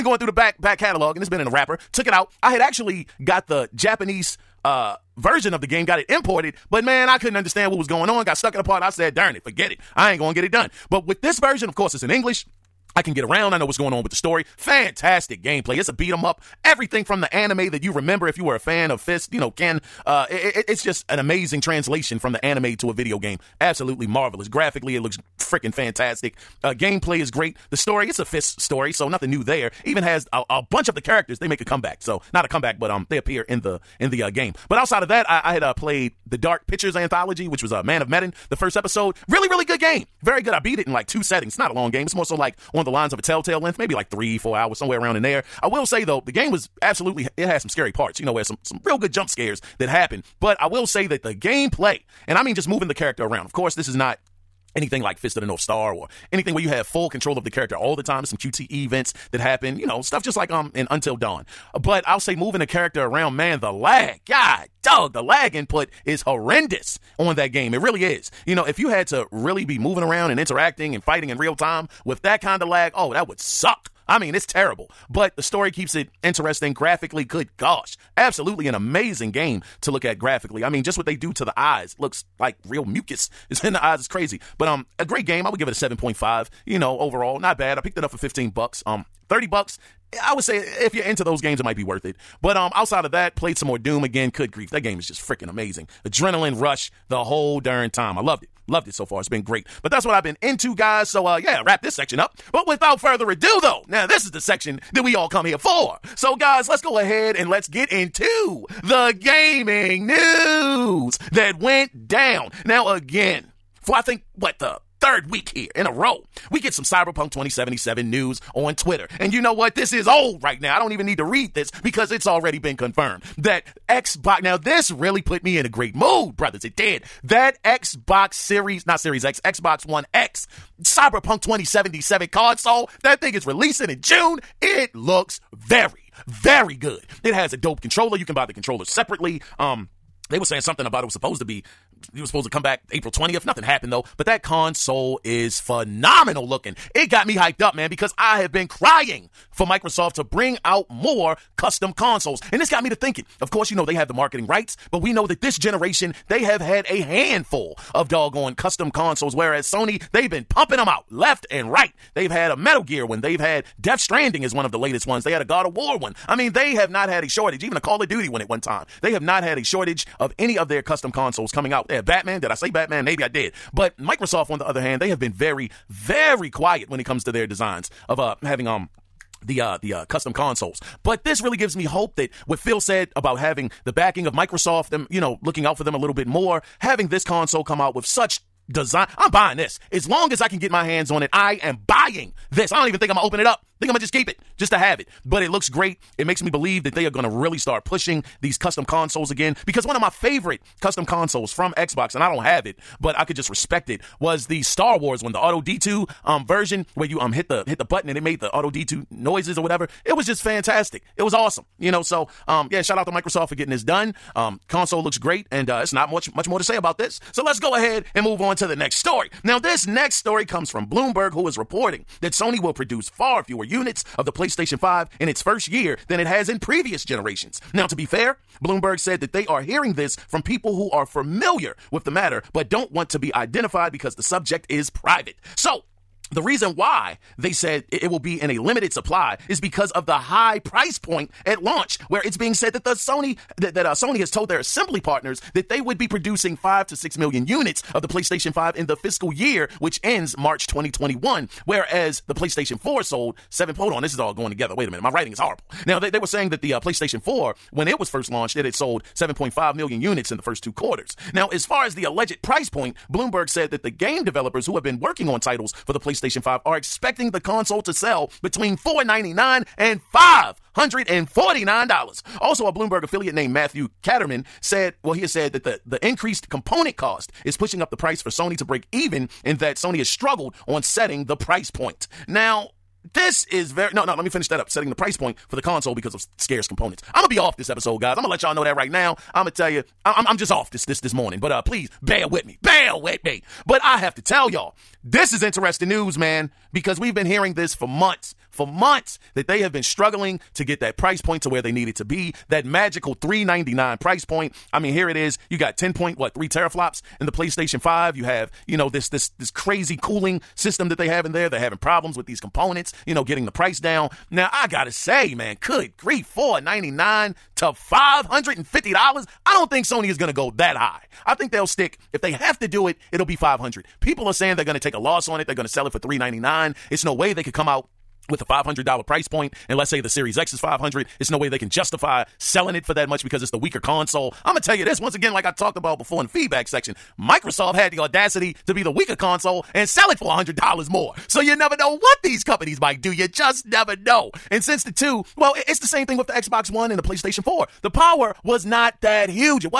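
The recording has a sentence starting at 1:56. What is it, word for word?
We get some Cyberpunk 2077 news on Twitter.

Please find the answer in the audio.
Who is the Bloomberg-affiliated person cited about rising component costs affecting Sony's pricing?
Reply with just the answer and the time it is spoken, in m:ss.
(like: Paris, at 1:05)
Matthew Kanterman, at 4:33.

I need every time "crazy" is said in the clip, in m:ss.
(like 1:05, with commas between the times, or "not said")
1:24, 5:09.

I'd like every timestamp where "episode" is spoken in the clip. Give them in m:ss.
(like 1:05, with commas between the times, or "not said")
0:38, 4:47.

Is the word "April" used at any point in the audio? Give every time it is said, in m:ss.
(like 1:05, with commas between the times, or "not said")
2:22.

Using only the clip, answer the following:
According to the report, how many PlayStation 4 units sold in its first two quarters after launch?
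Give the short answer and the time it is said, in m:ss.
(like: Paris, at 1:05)
7.5 million, at 4:19.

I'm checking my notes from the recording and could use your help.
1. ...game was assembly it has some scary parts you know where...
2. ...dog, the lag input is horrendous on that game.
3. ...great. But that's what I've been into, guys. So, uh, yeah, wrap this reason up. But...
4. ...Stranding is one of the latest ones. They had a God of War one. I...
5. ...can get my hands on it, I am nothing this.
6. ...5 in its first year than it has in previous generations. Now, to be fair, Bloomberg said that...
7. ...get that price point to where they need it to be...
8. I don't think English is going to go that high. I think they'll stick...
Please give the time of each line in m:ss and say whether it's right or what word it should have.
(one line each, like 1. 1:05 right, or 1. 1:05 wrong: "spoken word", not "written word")
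1. 0:46 wrong: "absolutely", not "assembly"
2. 1:04 right
3. 1:39 wrong: "section", not "reason"
4. 2:43 right
5. 3:10 wrong: "buying", not "nothing"
6. 3:44 right
7. 5:00 right
8. 5:19 wrong: "Sony", not "English".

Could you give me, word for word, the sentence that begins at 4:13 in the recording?
Hold on, this is all going together.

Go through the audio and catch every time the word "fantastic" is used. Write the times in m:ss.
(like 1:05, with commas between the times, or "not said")
0:14, 0:25, 3:30.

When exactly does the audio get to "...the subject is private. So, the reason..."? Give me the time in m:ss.
3:54.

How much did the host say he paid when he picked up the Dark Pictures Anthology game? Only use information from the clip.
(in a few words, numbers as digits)
$15.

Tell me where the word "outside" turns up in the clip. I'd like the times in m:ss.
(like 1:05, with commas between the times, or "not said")
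0:34, 1:32.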